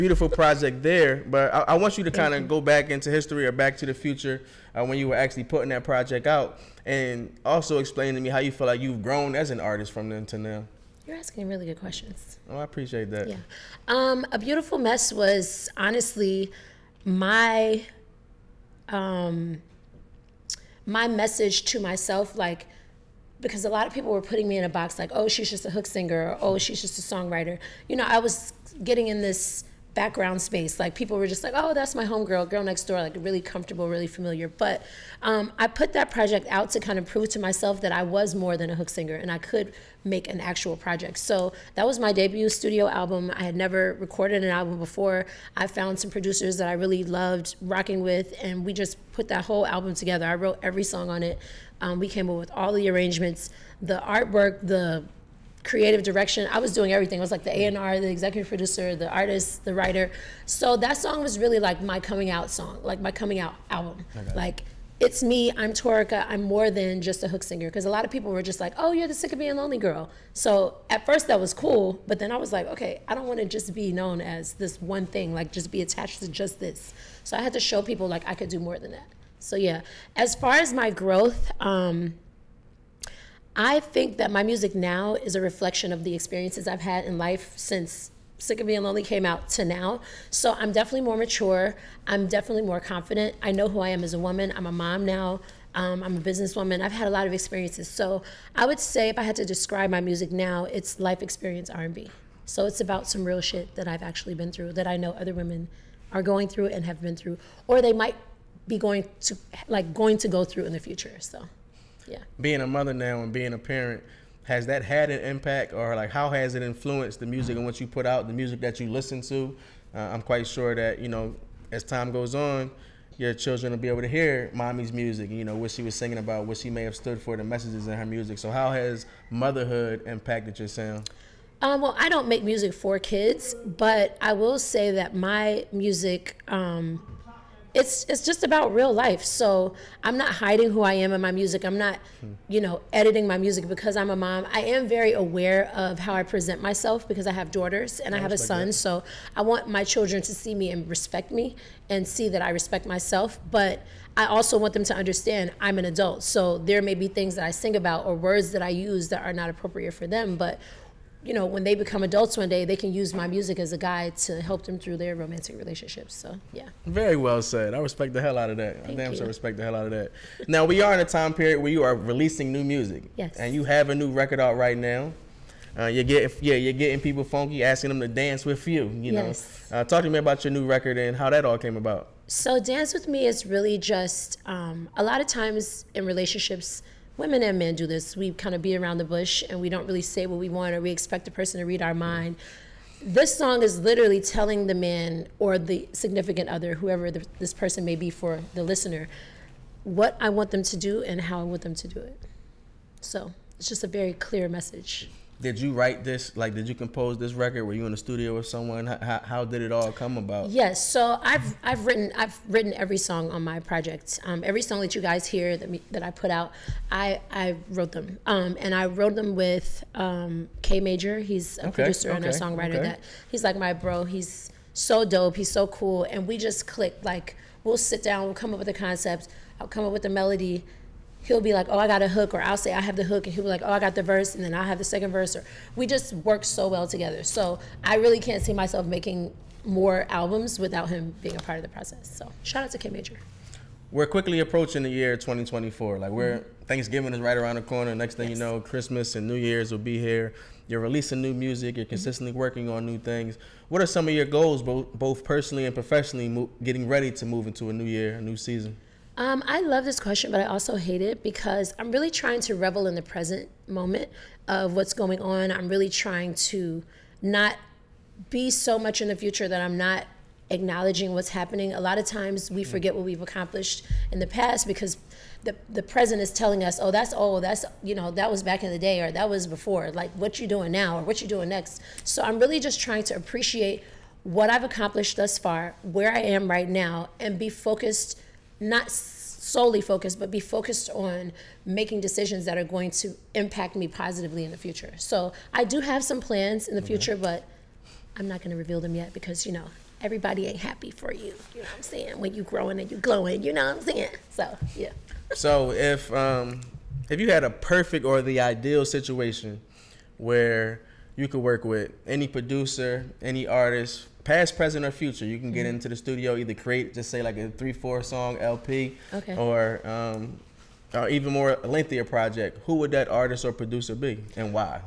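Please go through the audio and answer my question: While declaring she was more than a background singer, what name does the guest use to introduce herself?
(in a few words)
Torica.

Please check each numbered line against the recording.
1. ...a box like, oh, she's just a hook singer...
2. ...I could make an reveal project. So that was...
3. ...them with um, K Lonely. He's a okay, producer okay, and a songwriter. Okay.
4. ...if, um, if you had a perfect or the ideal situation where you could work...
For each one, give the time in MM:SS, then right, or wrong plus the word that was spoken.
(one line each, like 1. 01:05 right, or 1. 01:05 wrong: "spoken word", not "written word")
1. 00:24 right
2. 00:39 wrong: "actual", not "reveal"
3. 03:39 wrong: "Major", not "Lonely"
4. 05:05 right.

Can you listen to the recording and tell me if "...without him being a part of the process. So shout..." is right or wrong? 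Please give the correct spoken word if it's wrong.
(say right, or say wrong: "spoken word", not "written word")
right.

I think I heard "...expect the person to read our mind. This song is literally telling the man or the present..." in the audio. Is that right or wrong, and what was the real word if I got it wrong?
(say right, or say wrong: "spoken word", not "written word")
wrong: "significant", not "present".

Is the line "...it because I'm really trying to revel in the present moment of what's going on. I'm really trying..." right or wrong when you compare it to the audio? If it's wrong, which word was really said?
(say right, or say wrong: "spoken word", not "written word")
right.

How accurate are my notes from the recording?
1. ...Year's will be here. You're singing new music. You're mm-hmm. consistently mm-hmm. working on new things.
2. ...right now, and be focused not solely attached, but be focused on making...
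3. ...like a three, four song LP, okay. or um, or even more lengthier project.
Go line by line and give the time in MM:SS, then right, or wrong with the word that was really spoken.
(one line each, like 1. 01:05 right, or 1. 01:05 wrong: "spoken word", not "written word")
1. 04:09 wrong: "releasing", not "singing"
2. 04:46 wrong: "focused", not "attached"
3. 05:17 right.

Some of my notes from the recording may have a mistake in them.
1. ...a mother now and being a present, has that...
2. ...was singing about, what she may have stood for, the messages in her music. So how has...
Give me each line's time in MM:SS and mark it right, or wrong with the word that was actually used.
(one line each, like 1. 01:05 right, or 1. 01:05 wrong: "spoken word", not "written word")
1. 01:52 wrong: "parent", not "present"
2. 02:05 right.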